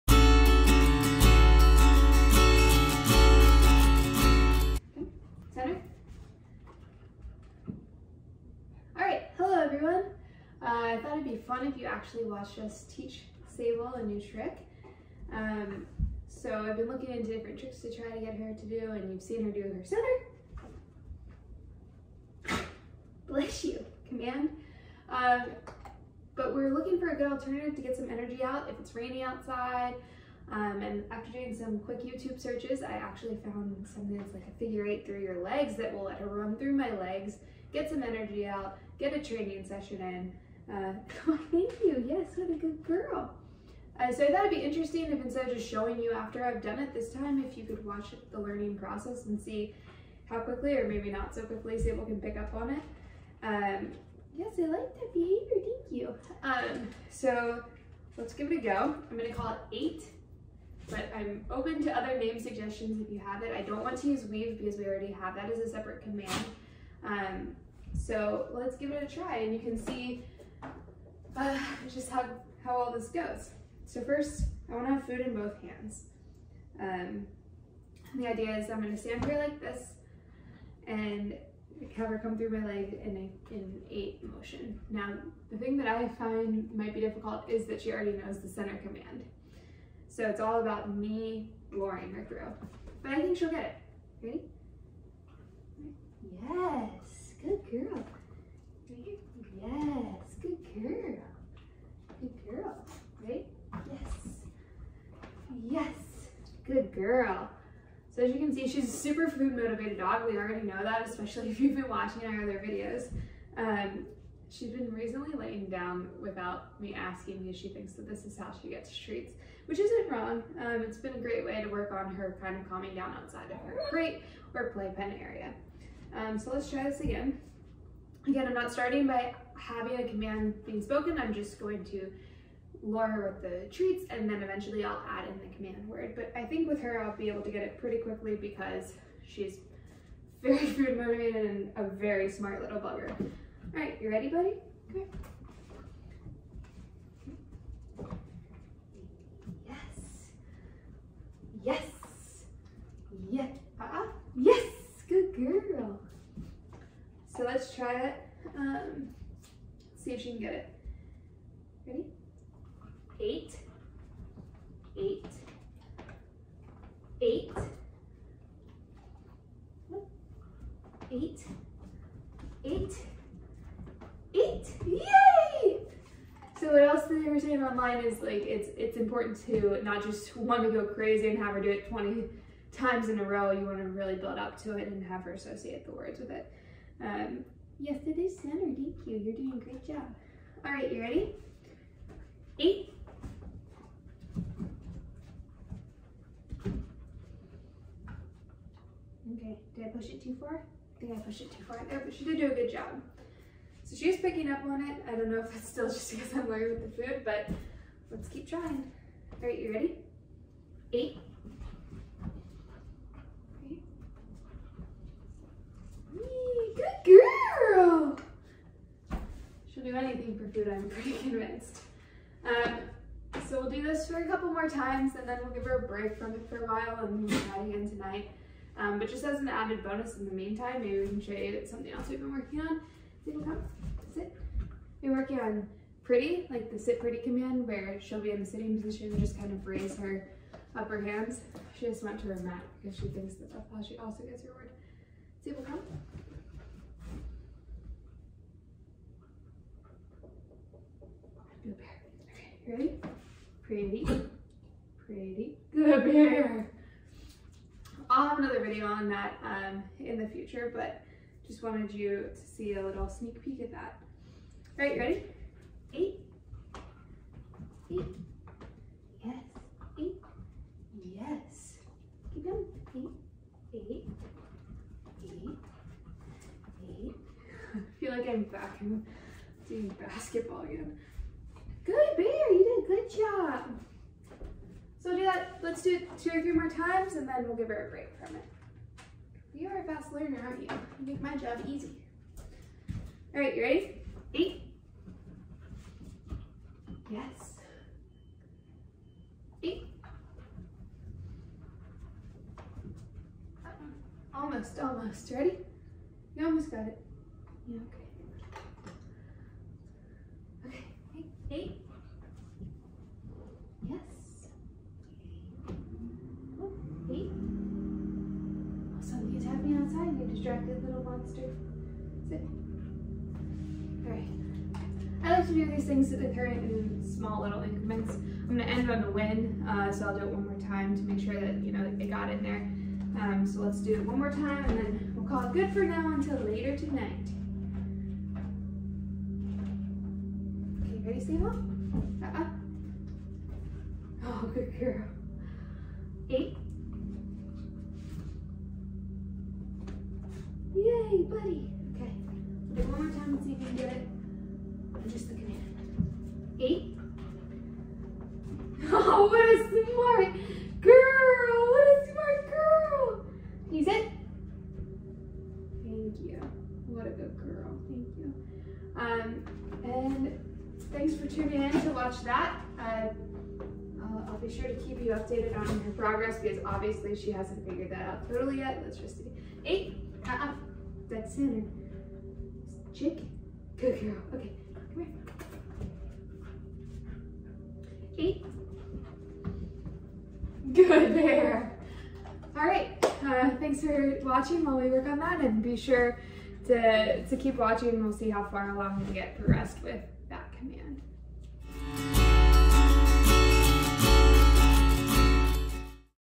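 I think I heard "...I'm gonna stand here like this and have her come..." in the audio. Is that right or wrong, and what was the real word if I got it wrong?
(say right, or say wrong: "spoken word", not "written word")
right.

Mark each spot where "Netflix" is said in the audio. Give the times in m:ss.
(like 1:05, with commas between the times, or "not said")
not said.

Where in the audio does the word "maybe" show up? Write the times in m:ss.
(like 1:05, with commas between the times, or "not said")
0:50, 3:50.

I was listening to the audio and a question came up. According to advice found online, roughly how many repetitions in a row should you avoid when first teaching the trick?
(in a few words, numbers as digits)
20.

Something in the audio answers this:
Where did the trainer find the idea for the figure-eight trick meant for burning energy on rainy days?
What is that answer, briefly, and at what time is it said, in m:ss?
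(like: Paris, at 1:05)
YouTube, at 0:32.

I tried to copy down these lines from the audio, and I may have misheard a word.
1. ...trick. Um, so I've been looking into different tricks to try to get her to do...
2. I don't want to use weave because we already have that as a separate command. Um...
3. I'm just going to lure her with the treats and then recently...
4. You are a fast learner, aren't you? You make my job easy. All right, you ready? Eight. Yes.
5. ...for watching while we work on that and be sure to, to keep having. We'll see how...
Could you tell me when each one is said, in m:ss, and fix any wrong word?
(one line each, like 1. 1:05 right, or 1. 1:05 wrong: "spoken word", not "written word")
1. 0:14 right
2. 1:03 right
3. 2:11 wrong: "eventually", not "recently"
4. 4:49 right
5. 6:33 wrong: "watching", not "having".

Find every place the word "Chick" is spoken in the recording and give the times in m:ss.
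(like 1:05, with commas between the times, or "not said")
6:22.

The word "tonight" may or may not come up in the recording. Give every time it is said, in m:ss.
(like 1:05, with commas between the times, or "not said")
3:47, 5:36.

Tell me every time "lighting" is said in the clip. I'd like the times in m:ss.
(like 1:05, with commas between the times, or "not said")
not said.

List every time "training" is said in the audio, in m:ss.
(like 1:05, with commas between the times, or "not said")
0:39.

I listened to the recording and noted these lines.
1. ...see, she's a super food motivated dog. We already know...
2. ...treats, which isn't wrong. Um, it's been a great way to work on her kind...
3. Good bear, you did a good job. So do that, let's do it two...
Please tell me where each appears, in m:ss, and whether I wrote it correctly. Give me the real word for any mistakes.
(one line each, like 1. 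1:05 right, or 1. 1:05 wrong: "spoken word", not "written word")
1. 1:48 right
2. 1:58 right
3. 4:41 right.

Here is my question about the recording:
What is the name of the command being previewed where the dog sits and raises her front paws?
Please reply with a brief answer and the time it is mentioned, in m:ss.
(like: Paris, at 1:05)
sit pretty, at 3:56.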